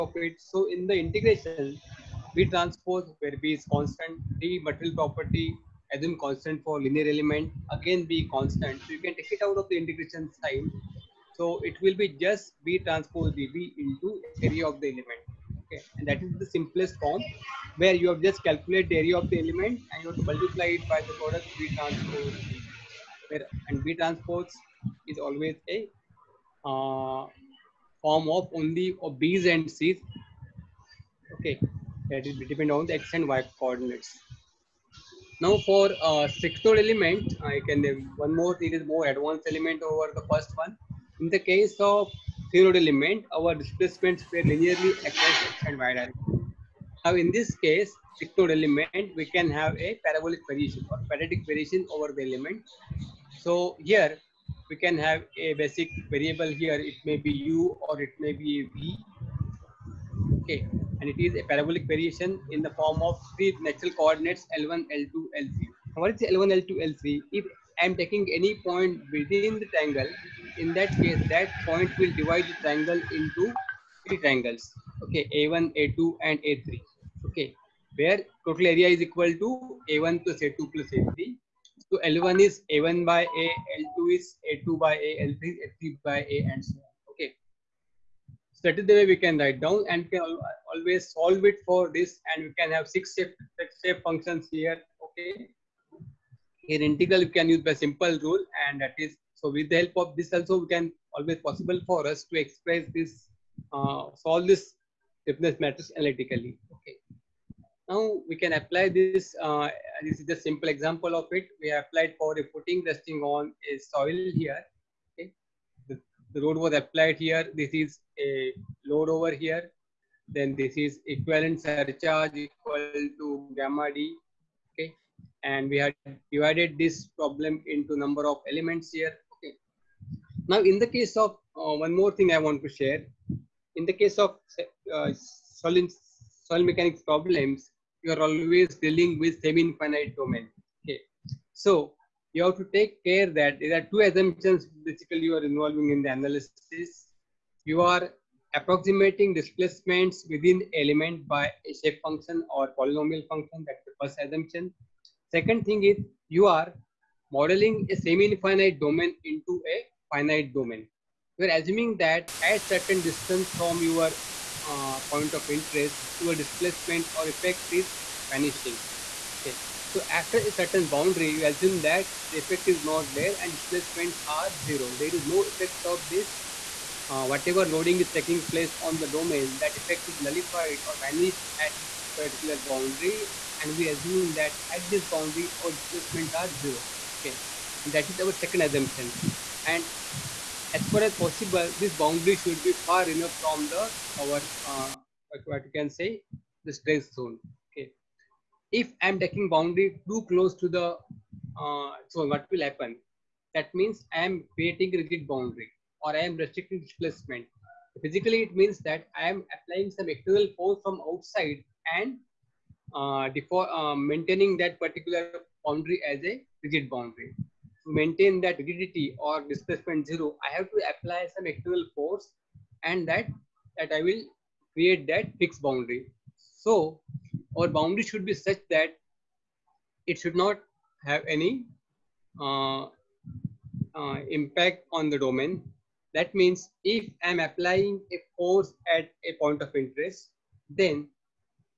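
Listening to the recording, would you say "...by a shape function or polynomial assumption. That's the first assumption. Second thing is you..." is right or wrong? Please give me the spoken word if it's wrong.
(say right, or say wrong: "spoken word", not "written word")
wrong: "function", not "assumption".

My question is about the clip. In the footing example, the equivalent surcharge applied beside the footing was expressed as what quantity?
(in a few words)
gamma d.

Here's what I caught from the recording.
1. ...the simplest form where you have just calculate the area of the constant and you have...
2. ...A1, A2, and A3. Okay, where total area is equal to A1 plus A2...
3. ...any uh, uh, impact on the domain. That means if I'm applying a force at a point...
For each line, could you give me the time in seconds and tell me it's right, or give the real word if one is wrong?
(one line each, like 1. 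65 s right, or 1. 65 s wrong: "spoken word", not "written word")
1. 16 s wrong: "element", not "constant"
2. 75 s right
3. 231 s right.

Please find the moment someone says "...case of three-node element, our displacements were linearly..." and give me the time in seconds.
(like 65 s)
41 s.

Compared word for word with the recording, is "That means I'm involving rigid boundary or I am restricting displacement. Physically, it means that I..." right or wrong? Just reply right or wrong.
wrong.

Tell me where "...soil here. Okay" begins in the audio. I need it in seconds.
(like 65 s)
113 s.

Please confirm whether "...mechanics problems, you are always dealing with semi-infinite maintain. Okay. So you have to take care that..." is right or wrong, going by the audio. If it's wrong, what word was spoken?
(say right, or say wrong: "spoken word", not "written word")
wrong: "domain", not "maintain".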